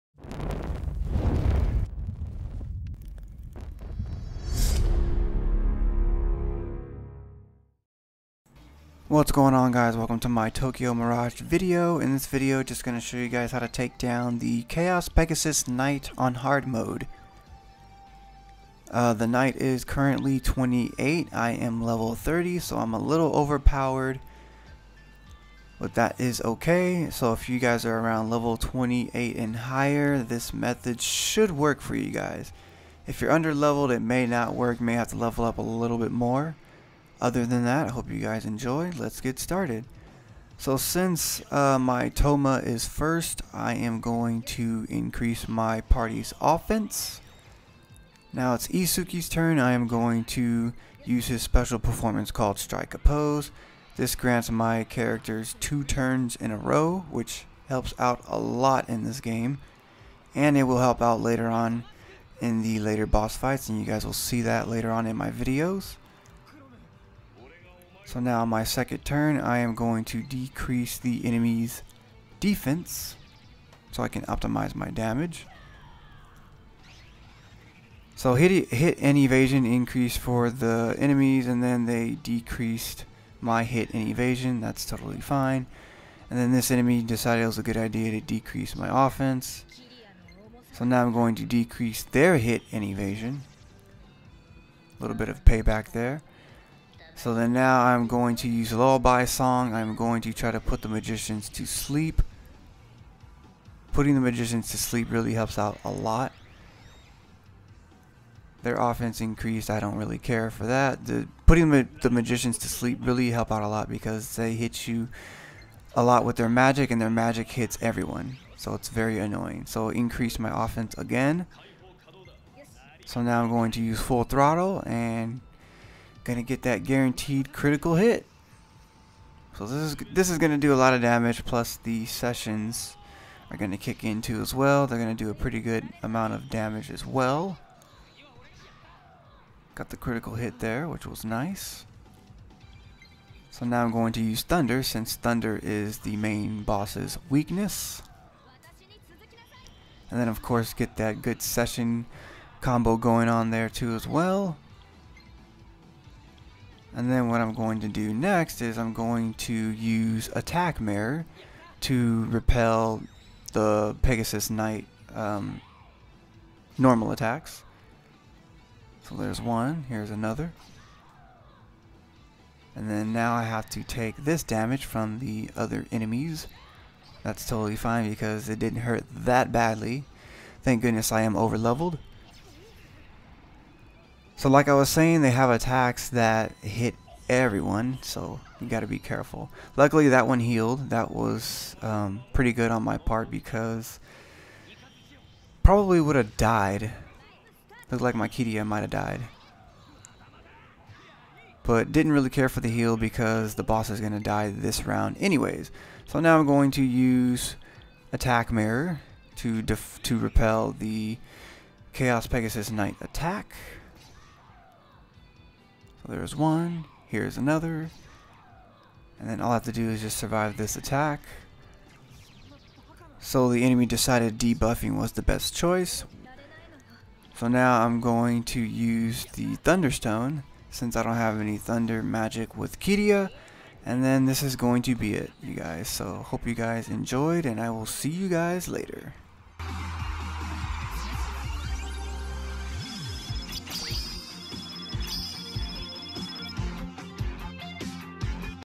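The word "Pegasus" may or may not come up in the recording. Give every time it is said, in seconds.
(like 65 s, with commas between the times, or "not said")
15 s, 164 s, 212 s.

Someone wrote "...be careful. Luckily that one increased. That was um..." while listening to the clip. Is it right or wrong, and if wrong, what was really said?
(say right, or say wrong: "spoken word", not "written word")
wrong: "healed", not "increased".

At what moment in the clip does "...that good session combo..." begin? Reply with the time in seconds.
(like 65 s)
150 s.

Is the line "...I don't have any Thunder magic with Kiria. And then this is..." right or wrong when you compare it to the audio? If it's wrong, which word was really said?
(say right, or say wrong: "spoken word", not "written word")
right.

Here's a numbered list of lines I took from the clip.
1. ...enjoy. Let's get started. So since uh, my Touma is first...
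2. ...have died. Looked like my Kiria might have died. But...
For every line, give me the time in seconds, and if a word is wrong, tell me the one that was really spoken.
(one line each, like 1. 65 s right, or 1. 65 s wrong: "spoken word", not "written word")
1. 38 s right
2. 196 s right.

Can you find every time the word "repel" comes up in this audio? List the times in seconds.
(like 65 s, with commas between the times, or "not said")
162 s, 210 s.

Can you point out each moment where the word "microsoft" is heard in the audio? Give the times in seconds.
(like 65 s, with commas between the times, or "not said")
not said.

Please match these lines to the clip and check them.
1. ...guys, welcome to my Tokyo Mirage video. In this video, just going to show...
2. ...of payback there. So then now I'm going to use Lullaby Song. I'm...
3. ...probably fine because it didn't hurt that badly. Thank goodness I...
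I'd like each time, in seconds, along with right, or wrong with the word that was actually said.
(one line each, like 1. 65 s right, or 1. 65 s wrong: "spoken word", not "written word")
1. 9 s right
2. 95 s right
3. 177 s wrong: "totally", not "probably".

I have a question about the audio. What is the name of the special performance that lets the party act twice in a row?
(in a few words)
Strike a Pose.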